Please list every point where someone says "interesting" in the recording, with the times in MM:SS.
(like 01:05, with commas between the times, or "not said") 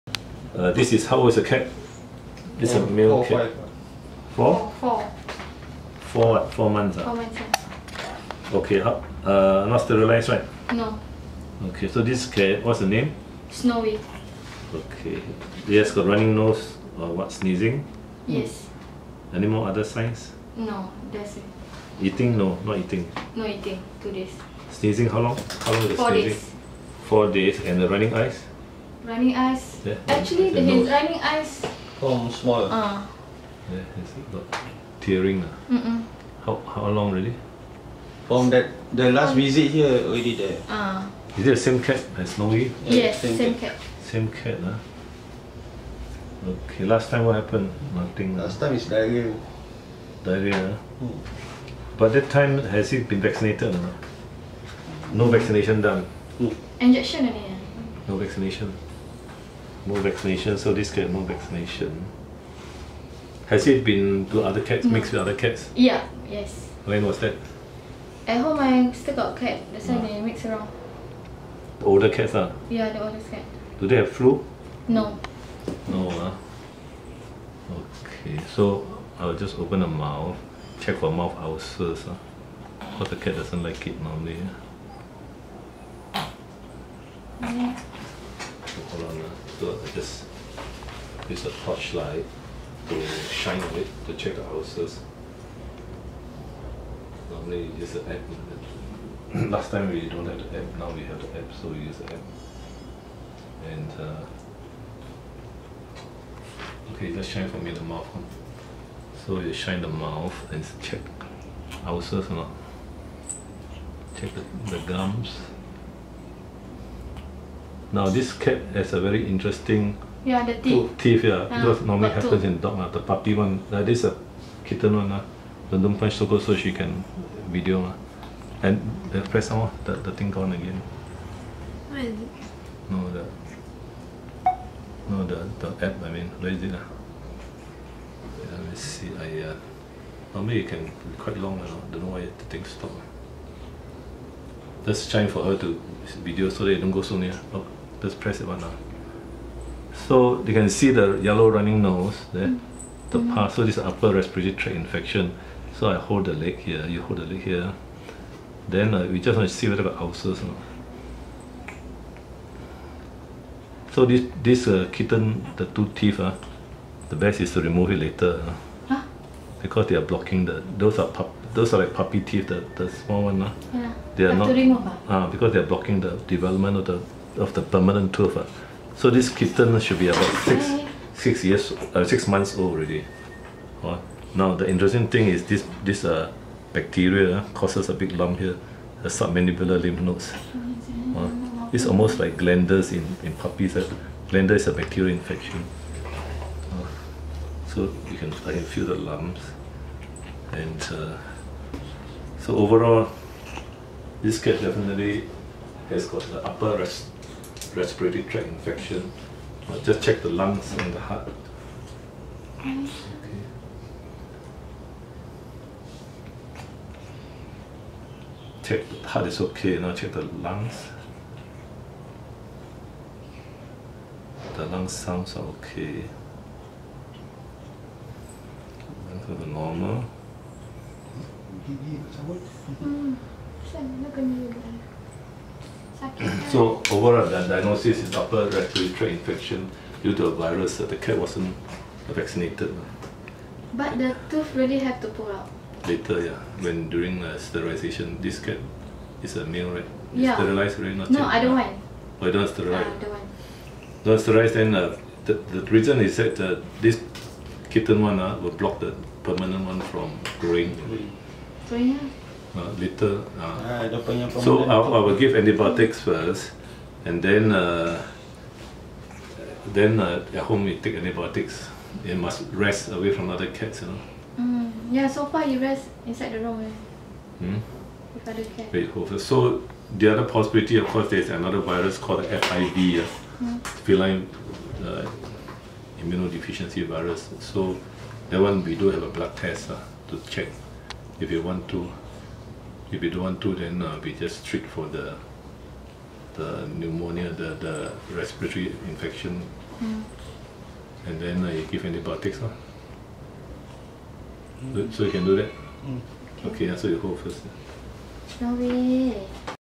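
01:59, 03:04.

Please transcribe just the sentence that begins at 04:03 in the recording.
But the tooth really have to pull out?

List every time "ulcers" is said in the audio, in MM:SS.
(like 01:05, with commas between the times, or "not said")
01:21, 02:39.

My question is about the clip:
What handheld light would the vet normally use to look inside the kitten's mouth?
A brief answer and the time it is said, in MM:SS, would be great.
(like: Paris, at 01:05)
torchlight, at 01:31.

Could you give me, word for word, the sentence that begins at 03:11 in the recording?
it's almost like glanders in, in puppies.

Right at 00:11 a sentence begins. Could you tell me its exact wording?
Okay, so this cat, what's the name?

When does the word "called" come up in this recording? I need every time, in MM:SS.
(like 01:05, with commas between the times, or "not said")
04:41.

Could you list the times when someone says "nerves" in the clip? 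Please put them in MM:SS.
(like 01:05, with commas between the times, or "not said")
not said.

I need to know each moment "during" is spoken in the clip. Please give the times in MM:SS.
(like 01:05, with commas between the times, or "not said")
04:06.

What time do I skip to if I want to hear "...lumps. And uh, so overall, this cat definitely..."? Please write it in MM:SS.
03:18.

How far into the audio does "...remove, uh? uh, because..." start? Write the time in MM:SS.
02:54.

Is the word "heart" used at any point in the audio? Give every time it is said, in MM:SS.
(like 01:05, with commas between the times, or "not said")
03:30, 03:39.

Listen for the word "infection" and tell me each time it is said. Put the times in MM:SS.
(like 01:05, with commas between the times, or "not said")
02:34, 03:15, 03:28, 03:59, 04:58.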